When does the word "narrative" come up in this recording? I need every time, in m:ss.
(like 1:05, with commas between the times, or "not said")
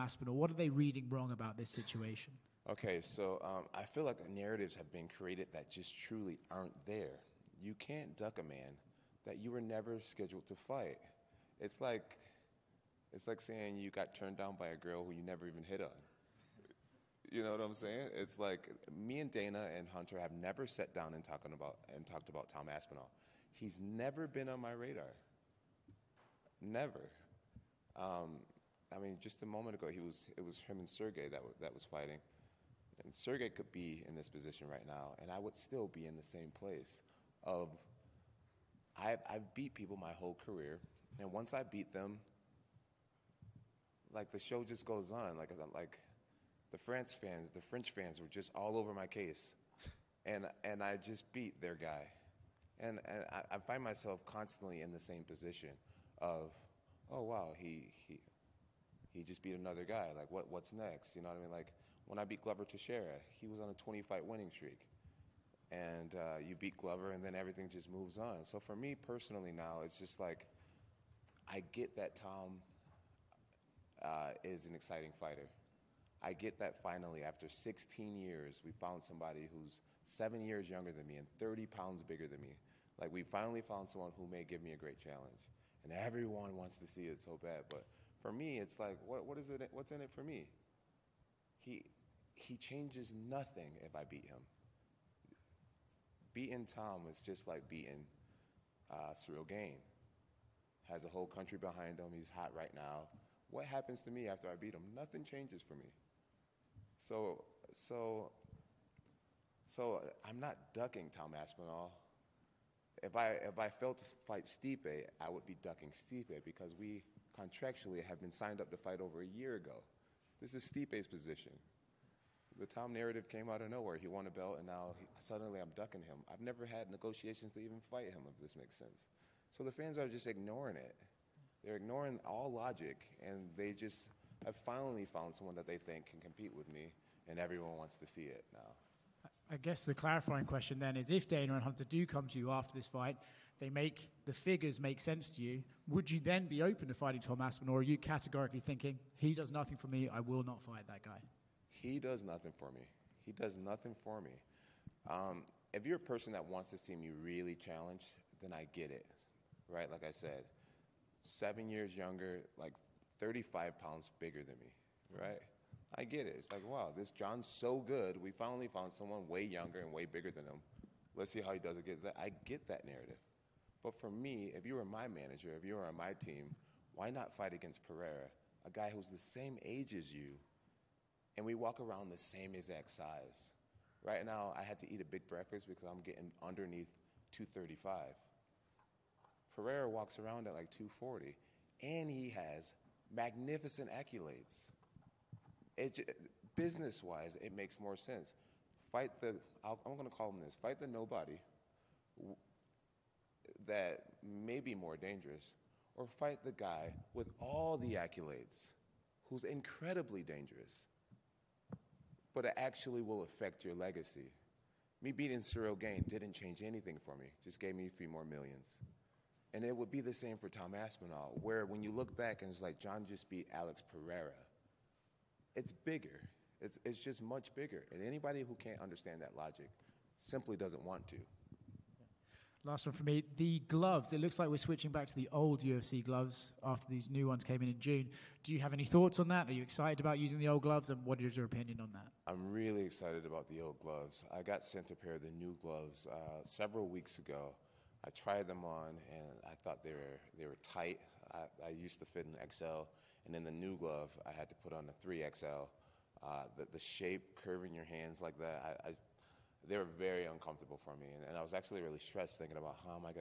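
0:04, 2:02, 2:52.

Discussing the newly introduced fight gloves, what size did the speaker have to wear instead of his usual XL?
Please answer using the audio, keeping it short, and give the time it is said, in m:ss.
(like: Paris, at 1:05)
3XL, at 4:15.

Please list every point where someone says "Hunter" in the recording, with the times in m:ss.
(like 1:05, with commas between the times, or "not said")
0:19, 2:21.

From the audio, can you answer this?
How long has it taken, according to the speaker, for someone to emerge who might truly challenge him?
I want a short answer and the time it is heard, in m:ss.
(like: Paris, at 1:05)
16 years, at 1:17.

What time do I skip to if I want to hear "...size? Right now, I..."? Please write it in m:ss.
3:02.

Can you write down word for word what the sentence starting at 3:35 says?
Me beating Ciryl Gane didn't change anything for me, just gave me a few more millions.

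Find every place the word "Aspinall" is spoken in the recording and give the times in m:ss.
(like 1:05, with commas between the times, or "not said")
0:22, 1:51, 2:27, 3:40.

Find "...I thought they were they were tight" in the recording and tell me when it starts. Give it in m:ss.
4:09.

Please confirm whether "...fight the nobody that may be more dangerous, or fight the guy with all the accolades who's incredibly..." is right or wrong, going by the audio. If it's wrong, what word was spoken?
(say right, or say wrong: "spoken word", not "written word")
right.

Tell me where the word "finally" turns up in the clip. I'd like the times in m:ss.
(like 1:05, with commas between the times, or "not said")
1:16, 1:23, 2:14, 2:48.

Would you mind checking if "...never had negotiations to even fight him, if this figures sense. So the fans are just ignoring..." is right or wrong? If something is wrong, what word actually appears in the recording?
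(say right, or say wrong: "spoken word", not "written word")
wrong: "makes", not "figures".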